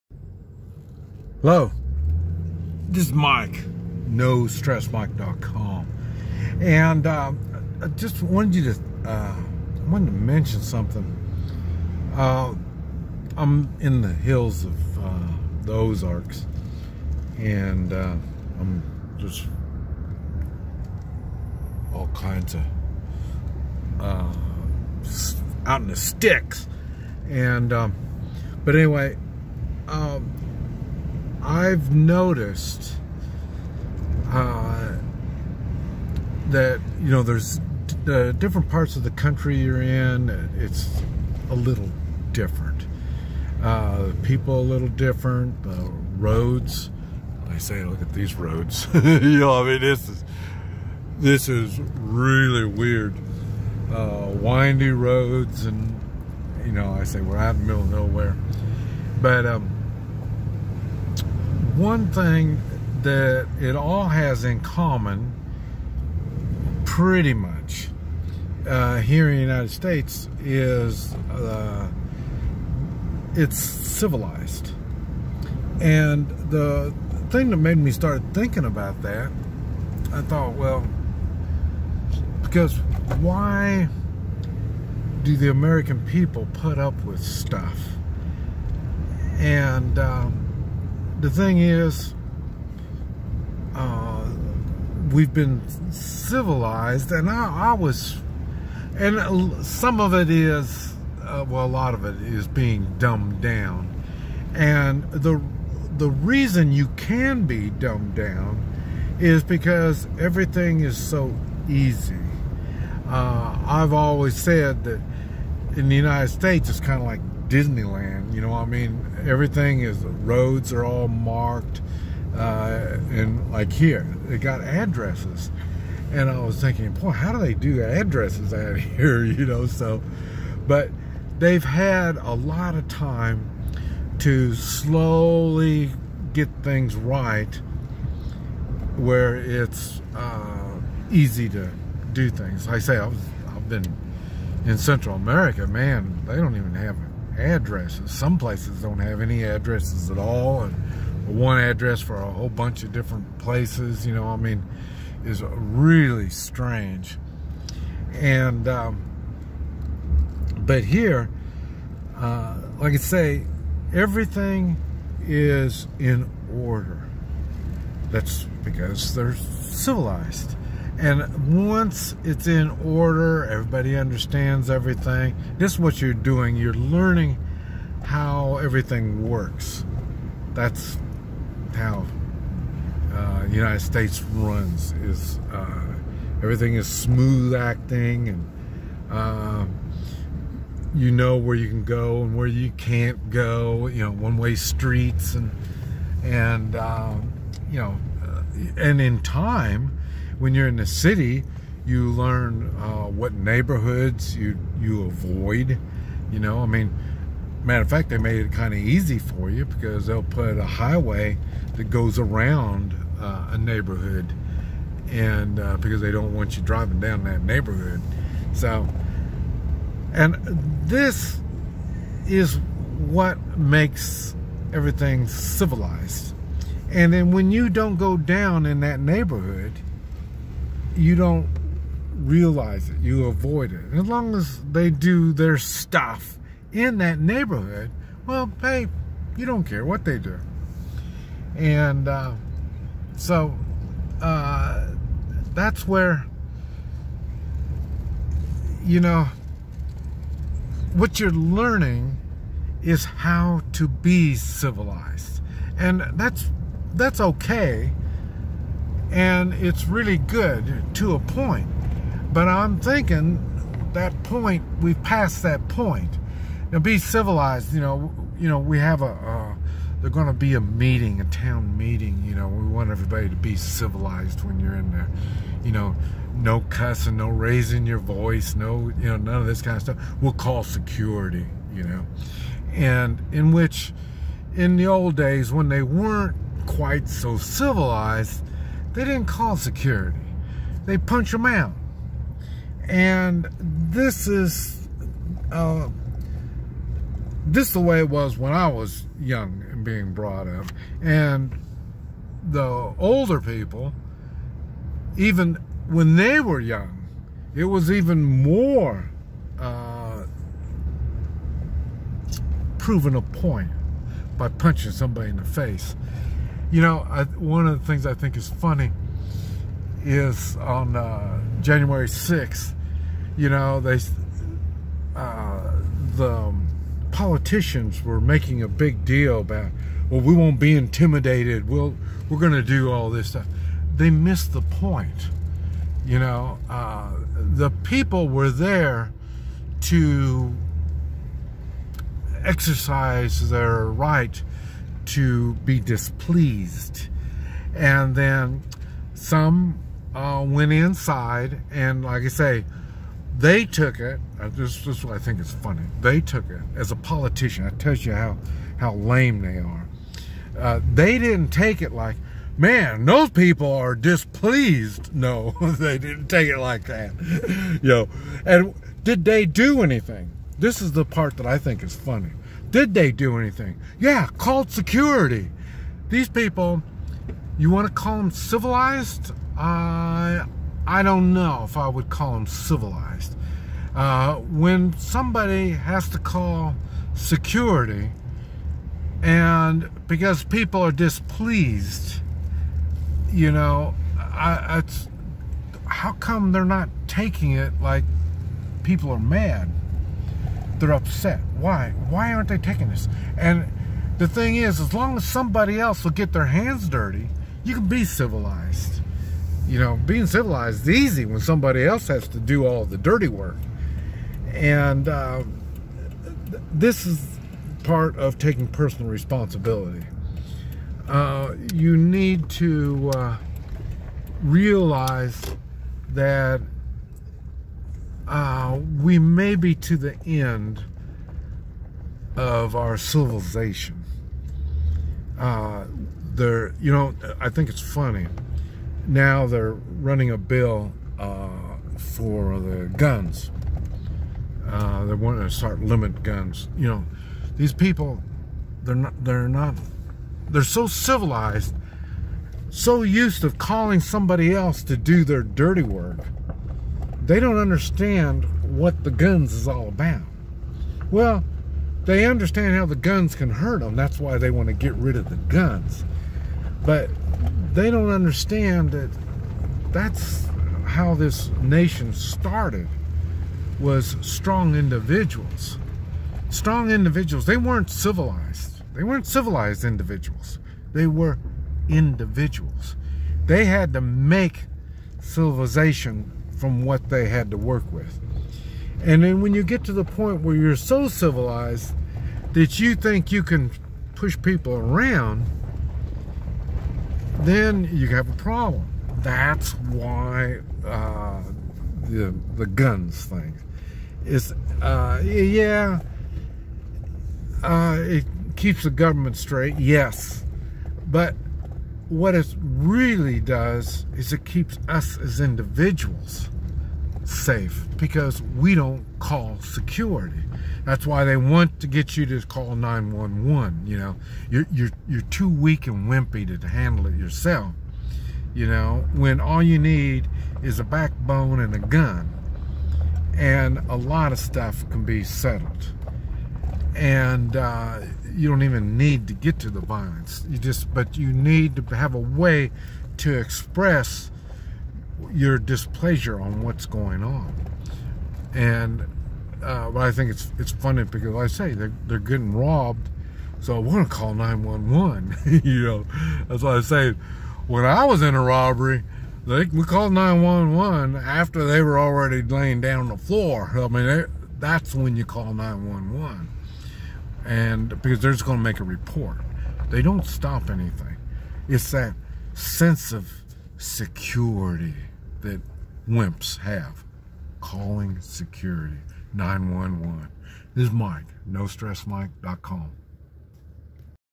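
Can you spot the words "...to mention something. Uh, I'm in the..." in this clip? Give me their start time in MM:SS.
00:10.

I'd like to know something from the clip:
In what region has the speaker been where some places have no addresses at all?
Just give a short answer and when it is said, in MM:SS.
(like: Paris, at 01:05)
Central America, at 02:24.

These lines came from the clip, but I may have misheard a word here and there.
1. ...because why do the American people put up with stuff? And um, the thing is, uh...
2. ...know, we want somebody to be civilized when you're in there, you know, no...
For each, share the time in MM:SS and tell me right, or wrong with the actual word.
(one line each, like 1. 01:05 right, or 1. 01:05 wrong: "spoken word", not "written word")
1. 01:22 right
2. 04:32 wrong: "everybody", not "somebody".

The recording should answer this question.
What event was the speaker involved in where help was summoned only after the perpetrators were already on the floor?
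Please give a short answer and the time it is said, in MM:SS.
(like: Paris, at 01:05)
a robbery, at 09:18.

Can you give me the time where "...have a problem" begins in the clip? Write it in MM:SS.
08:18.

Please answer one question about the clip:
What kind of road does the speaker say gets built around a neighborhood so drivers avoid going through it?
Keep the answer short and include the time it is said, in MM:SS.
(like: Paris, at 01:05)
highway, at 03:30.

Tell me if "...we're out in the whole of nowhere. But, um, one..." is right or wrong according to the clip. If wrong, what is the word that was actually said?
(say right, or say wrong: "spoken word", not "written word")
wrong: "middle", not "whole".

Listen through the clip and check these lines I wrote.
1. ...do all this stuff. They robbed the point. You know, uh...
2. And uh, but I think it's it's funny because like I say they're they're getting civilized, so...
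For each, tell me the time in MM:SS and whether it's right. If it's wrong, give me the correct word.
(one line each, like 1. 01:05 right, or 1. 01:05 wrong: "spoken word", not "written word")
1. 05:32 wrong: "missed", not "robbed"
2. 09:08 wrong: "robbed", not "civilized".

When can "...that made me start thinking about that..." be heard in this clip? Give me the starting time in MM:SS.
01:17.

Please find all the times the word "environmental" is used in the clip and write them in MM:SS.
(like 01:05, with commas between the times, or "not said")
not said.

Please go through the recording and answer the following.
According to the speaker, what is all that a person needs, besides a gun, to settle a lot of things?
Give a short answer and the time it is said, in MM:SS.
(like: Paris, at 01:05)
a backbone, at 08:50.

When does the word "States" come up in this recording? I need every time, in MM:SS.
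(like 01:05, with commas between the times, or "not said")
01:09, 01:56, 03:03.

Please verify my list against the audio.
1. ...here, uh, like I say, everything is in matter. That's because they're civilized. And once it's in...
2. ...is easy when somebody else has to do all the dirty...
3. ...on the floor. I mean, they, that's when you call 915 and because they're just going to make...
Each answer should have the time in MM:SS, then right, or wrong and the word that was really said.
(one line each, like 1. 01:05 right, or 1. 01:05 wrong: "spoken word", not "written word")
1. 02:40 wrong: "order", not "matter"
2. 06:50 right
3. 09:22 wrong: "911", not "915".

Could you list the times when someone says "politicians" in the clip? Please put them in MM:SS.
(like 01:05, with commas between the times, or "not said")
05:27, 05:56.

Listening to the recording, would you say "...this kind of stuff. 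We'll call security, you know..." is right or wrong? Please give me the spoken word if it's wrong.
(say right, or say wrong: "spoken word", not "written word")
right.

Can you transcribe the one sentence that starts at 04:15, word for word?
And that's that's okay and it's really good to a point.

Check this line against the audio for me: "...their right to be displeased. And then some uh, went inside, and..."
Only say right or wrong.
right.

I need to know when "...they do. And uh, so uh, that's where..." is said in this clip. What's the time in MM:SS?
04:00.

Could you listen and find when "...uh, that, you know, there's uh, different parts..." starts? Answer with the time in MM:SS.
00:34.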